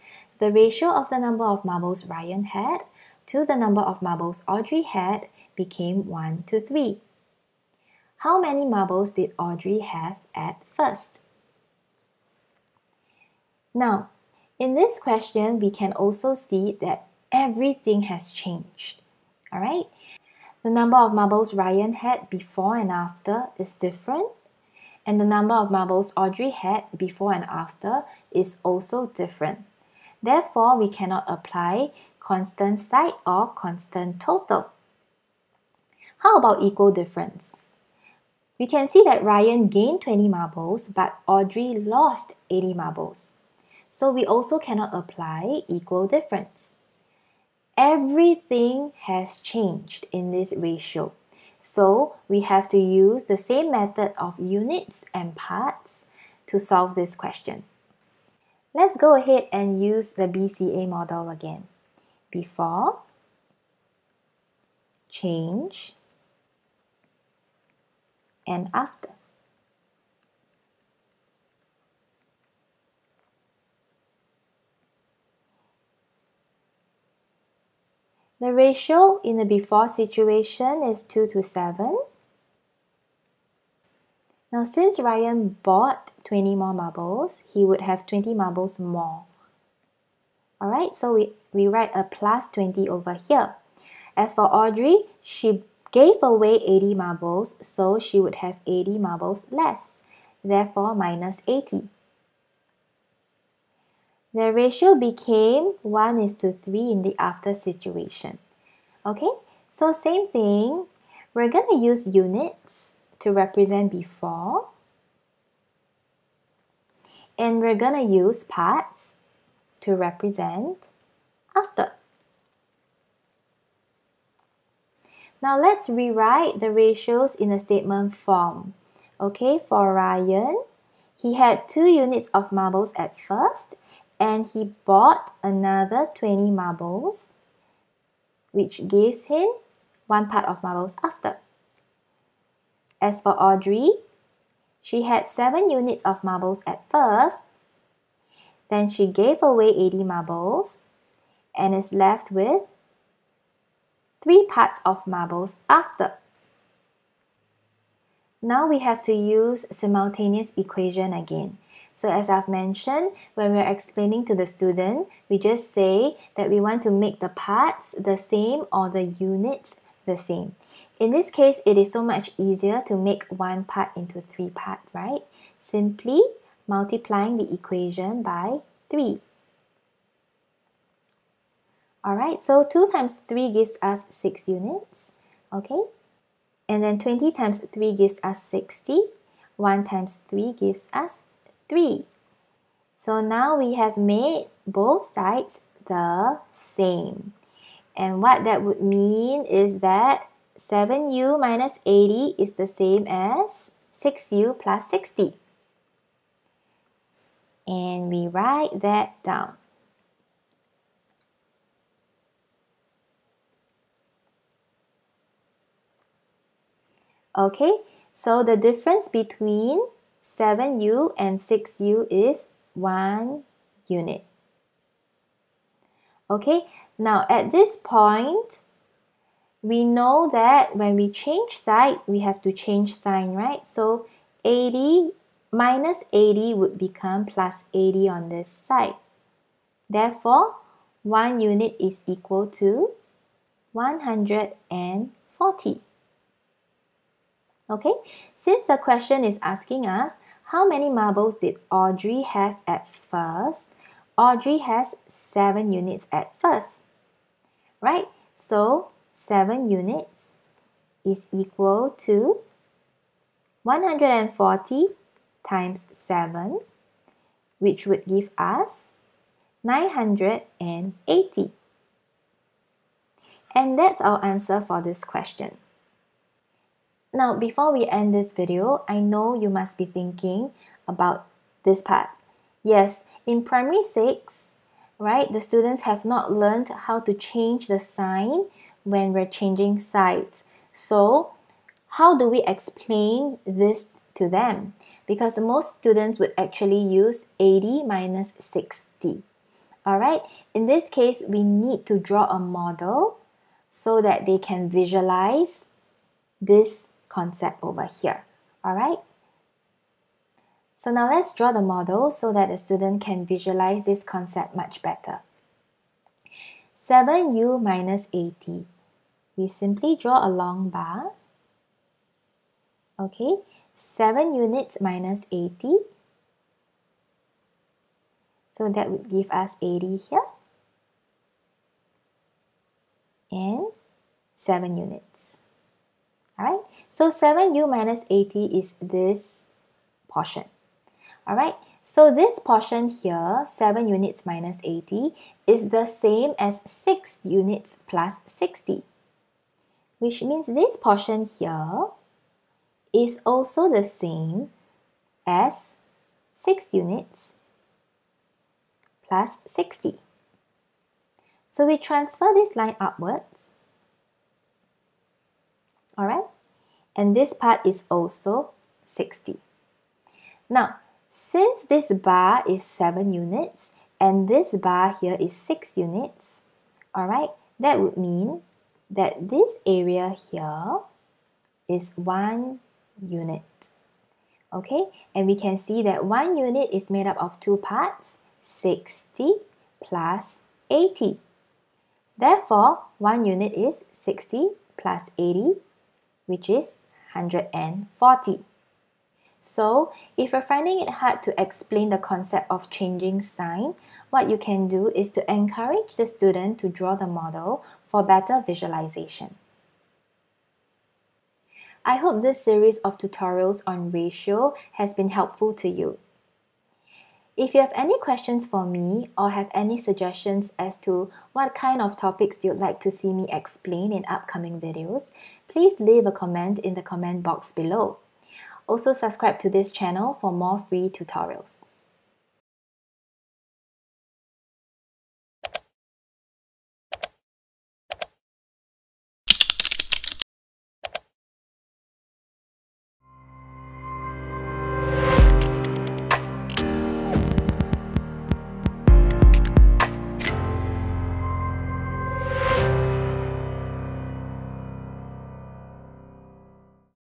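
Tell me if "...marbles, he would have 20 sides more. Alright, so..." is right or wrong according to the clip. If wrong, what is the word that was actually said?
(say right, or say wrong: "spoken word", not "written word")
wrong: "marbles", not "sides".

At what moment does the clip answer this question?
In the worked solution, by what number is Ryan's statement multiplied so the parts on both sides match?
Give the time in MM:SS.
02:56.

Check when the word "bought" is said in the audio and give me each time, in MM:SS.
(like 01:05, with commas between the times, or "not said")
01:25, 02:14.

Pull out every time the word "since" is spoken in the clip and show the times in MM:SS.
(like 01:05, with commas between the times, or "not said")
01:24, 04:08, 06:11.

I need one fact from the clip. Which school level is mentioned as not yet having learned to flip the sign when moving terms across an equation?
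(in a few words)
primary 6.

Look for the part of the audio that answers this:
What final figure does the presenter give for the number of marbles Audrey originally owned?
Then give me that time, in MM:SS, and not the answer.
04:29.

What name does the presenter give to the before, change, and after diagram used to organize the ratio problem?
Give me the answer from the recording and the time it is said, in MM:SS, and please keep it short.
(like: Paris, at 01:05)
BCA model, at 01:00.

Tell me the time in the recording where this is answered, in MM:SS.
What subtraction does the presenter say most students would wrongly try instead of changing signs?
04:57.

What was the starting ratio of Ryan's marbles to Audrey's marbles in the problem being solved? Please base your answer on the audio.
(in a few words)
2 to 7.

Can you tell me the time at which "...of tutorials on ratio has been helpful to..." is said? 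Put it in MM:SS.
06:52.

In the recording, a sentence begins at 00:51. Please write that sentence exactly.
So we have to use the same method of units and parts to solve this question.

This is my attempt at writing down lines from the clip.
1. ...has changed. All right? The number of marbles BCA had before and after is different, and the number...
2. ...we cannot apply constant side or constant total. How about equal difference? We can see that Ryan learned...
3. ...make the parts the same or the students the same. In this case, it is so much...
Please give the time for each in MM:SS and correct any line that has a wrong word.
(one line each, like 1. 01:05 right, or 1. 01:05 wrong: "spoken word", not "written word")
1. 00:18 wrong: "Ryan", not "BCA"
2. 00:30 wrong: "gained", not "learned"
3. 02:46 wrong: "units", not "students".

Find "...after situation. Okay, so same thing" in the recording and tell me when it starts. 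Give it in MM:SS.
01:47.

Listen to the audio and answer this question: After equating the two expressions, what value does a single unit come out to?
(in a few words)
140.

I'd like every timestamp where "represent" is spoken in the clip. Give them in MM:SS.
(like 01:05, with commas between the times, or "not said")
01:53, 01:59.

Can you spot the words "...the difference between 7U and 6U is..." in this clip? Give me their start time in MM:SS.
03:38.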